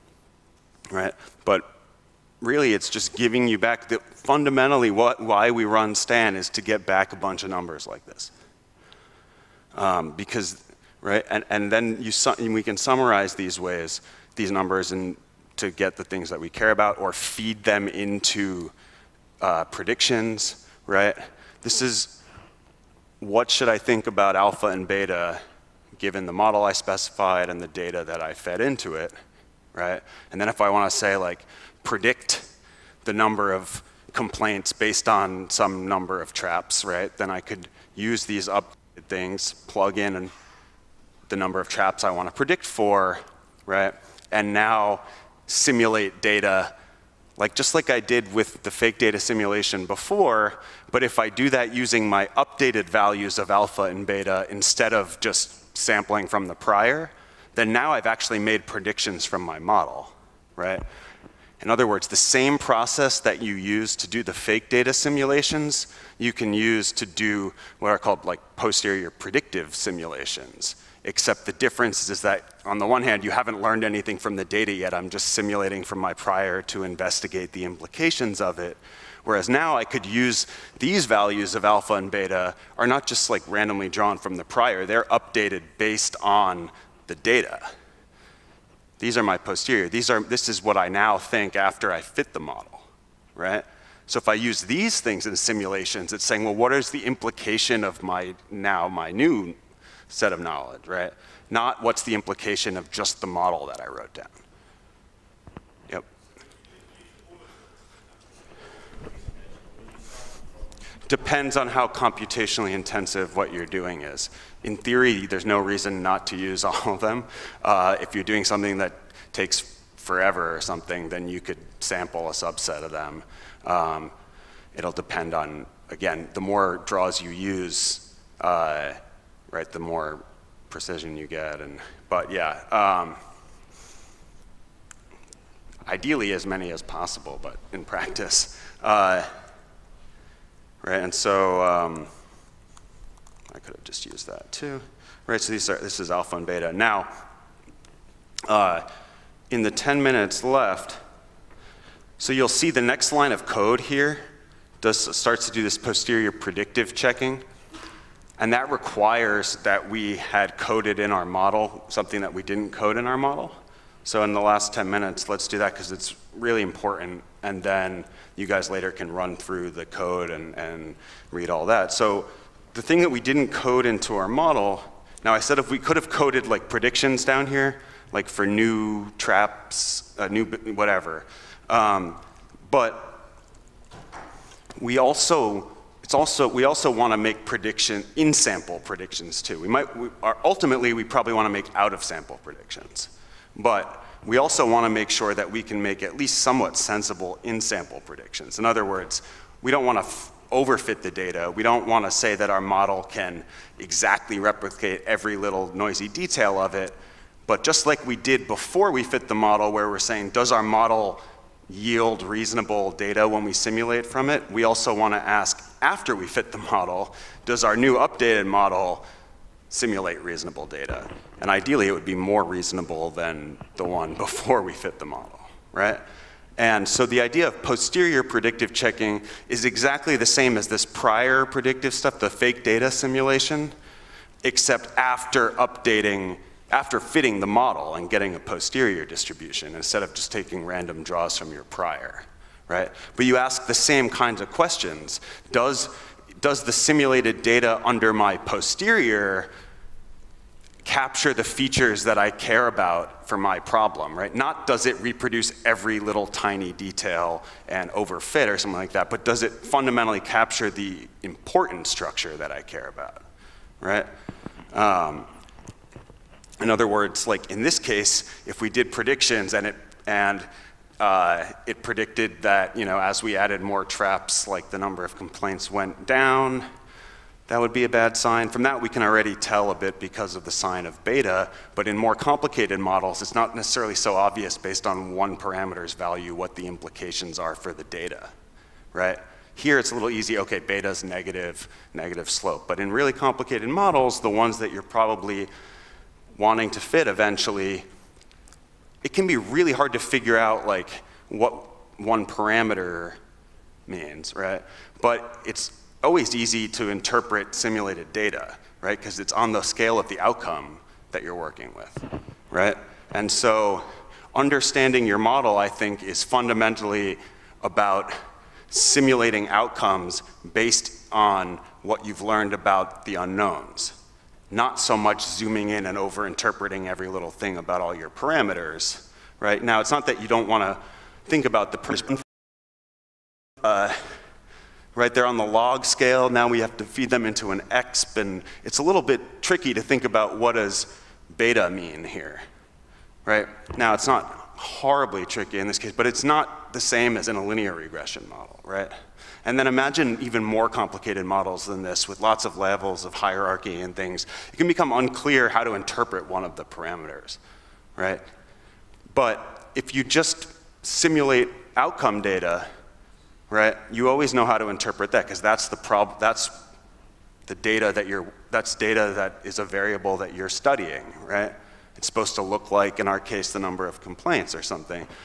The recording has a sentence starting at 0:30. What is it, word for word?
And then if I want to say like, predict the number of complaints based on some number of traps, right?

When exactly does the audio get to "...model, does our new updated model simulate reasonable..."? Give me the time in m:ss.
3:36.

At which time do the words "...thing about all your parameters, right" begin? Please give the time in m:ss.
5:27.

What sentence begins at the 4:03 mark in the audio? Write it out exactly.
But you ask the same kinds of questions.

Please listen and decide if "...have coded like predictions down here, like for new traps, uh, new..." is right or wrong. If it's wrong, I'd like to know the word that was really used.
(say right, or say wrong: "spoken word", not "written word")
right.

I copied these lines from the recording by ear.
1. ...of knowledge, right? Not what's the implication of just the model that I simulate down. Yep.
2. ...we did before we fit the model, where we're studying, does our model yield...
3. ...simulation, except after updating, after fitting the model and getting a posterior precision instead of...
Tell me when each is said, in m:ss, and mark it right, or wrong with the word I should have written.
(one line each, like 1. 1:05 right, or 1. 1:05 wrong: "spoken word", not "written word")
1. 1:40 wrong: "wrote", not "simulate"
2. 3:28 wrong: "saying", not "studying"
3. 3:52 wrong: "distribution", not "precision".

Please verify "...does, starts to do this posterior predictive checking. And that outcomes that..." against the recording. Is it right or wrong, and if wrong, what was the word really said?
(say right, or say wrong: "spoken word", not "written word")
wrong: "requires", not "outcomes".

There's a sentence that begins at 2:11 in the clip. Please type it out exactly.
And But yeah, um, ideally as many as possible, but in practice.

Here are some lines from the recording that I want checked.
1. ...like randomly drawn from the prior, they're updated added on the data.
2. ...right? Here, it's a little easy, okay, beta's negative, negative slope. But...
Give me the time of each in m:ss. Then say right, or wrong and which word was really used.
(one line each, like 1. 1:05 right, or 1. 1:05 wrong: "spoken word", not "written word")
1. 1:23 wrong: "based", not "added"
2. 4:48 right.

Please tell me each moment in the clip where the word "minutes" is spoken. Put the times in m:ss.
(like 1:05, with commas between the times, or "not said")
2:30, 2:44.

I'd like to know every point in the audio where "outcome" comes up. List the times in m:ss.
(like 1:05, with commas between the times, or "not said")
5:10, 5:19, 6:01.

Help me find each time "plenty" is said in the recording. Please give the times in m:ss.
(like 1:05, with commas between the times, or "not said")
not said.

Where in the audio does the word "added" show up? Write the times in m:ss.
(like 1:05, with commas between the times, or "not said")
4:33.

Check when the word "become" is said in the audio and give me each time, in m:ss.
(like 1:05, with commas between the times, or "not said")
5:54.